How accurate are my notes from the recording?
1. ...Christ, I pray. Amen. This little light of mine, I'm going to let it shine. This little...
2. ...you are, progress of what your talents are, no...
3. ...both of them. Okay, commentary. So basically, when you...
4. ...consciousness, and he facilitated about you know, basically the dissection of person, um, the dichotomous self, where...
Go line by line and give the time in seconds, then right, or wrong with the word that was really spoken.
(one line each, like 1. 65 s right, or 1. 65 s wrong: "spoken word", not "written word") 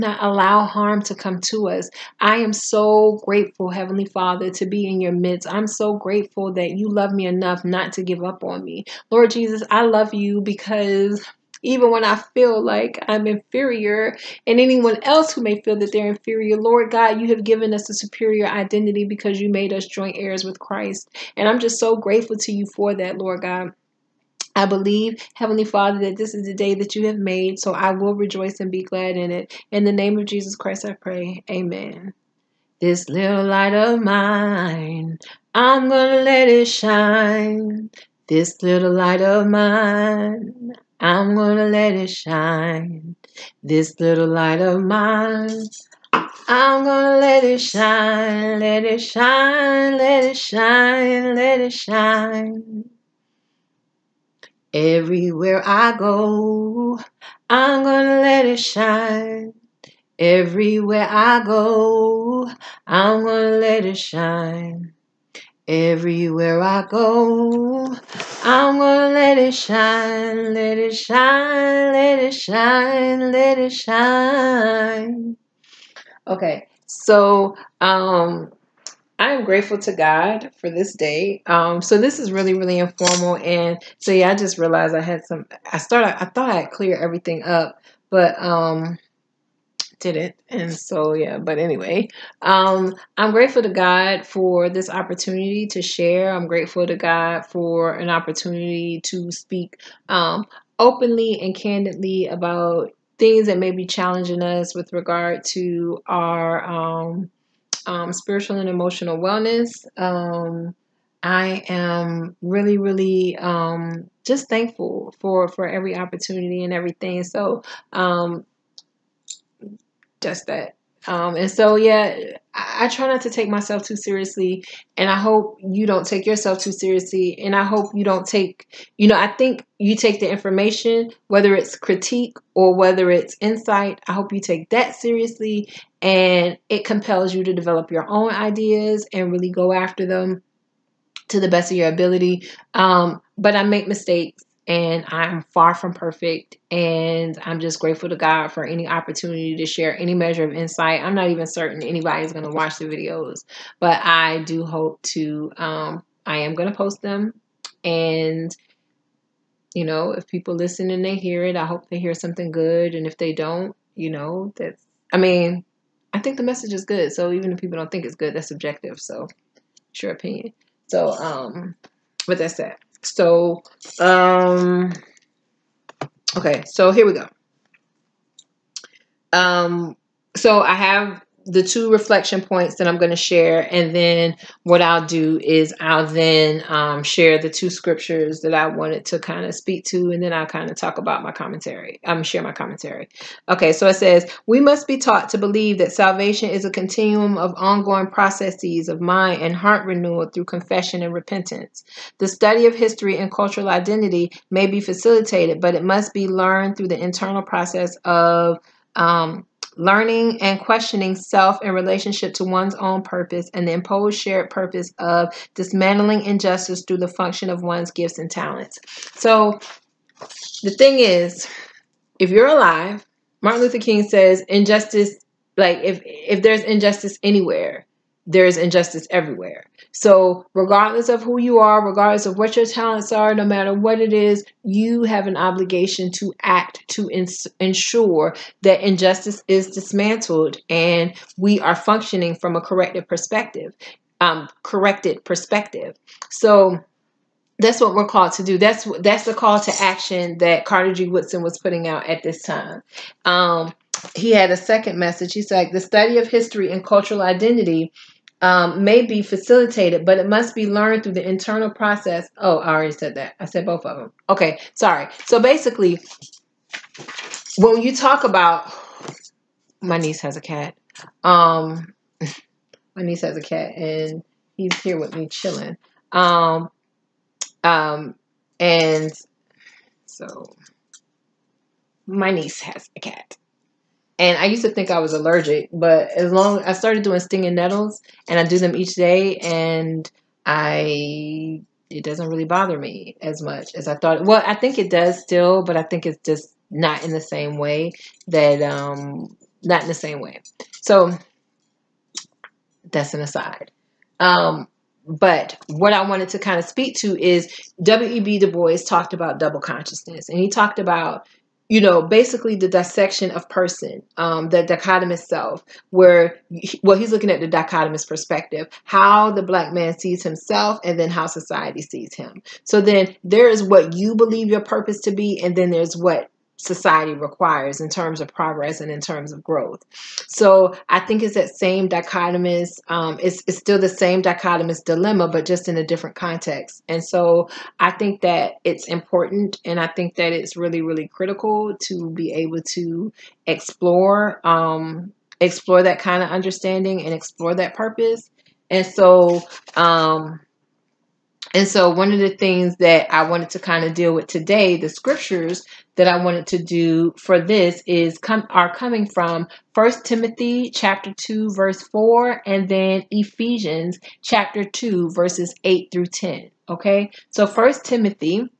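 1. 30 s right
2. 231 s wrong: "regardless", not "progress"
3. 263 s wrong: "sorry", not "commentary"
4. 309 s wrong: "talked", not "facilitated".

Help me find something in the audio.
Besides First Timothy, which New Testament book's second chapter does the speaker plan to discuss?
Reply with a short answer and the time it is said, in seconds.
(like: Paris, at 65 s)
Ephesians, at 363 s.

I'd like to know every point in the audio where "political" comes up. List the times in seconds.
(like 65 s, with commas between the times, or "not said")
not said.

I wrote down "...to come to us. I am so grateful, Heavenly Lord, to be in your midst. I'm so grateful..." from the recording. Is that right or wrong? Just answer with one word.
wrong.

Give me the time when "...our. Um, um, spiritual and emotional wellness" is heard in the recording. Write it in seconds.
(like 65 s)
106 s.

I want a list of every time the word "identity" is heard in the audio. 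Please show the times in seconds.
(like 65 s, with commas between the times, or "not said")
18 s, 203 s, 257 s.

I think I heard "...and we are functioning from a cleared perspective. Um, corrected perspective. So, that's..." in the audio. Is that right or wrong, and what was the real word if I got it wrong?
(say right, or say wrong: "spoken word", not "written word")
wrong: "corrected", not "cleared".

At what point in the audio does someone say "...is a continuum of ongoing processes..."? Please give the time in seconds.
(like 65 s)
196 s.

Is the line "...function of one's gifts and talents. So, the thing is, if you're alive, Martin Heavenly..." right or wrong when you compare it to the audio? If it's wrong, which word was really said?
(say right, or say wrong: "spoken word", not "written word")
wrong: "Luther", not "Heavenly".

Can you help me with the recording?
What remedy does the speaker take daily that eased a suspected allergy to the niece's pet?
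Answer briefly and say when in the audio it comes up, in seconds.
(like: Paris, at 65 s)
Stinging nettles, at 287 s.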